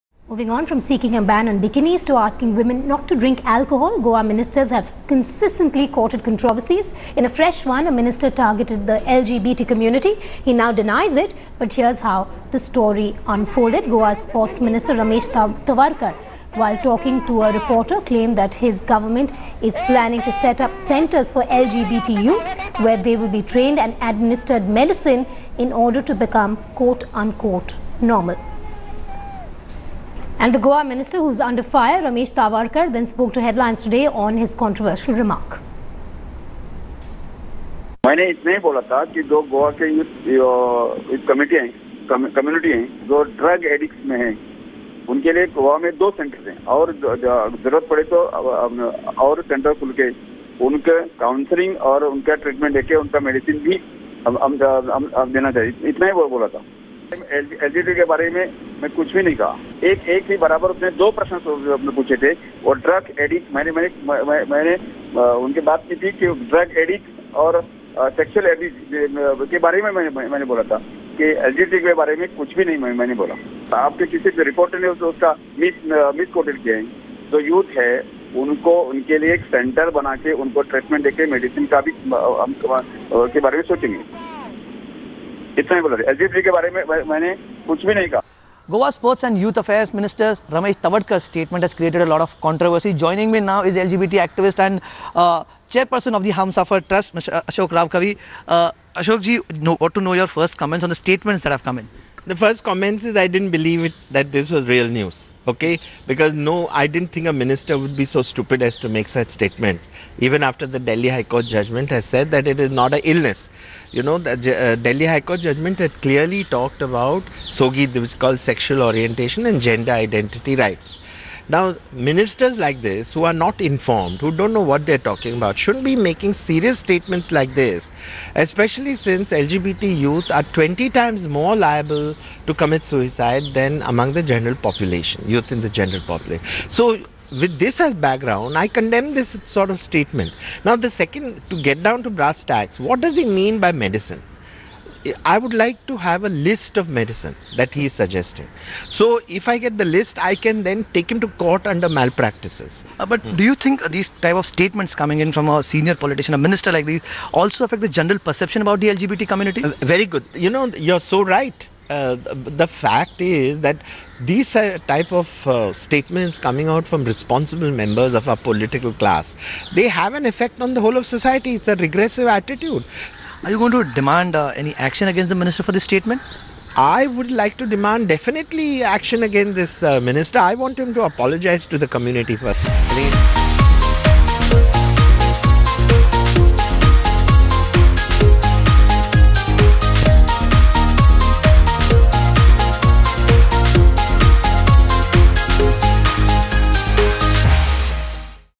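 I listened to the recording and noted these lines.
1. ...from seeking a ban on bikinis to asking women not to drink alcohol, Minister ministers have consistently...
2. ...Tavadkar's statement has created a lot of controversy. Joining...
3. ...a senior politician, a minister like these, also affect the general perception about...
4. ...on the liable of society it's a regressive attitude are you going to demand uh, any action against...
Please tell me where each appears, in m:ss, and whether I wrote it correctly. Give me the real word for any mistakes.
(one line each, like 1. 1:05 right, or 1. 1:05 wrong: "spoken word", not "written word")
1. 0:00 wrong: "Goa", not "Minister"
2. 1:30 right
3. 2:35 right
4. 2:50 wrong: "whole", not "liable".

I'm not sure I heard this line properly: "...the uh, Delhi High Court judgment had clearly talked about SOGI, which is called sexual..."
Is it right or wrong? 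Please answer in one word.
right.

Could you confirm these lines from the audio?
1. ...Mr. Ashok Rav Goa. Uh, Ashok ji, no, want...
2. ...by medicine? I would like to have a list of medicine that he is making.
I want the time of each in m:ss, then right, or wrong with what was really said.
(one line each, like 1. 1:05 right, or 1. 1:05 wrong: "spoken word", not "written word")
1. 1:37 wrong: "Kavi", not "Goa"
2. 2:23 wrong: "suggesting", not "making".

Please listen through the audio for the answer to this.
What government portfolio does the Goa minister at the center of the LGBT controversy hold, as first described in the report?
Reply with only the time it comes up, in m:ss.
0:14.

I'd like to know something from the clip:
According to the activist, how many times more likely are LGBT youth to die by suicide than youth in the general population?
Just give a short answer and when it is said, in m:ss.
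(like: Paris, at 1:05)
20, at 2:10.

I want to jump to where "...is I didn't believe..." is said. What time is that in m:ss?
1:43.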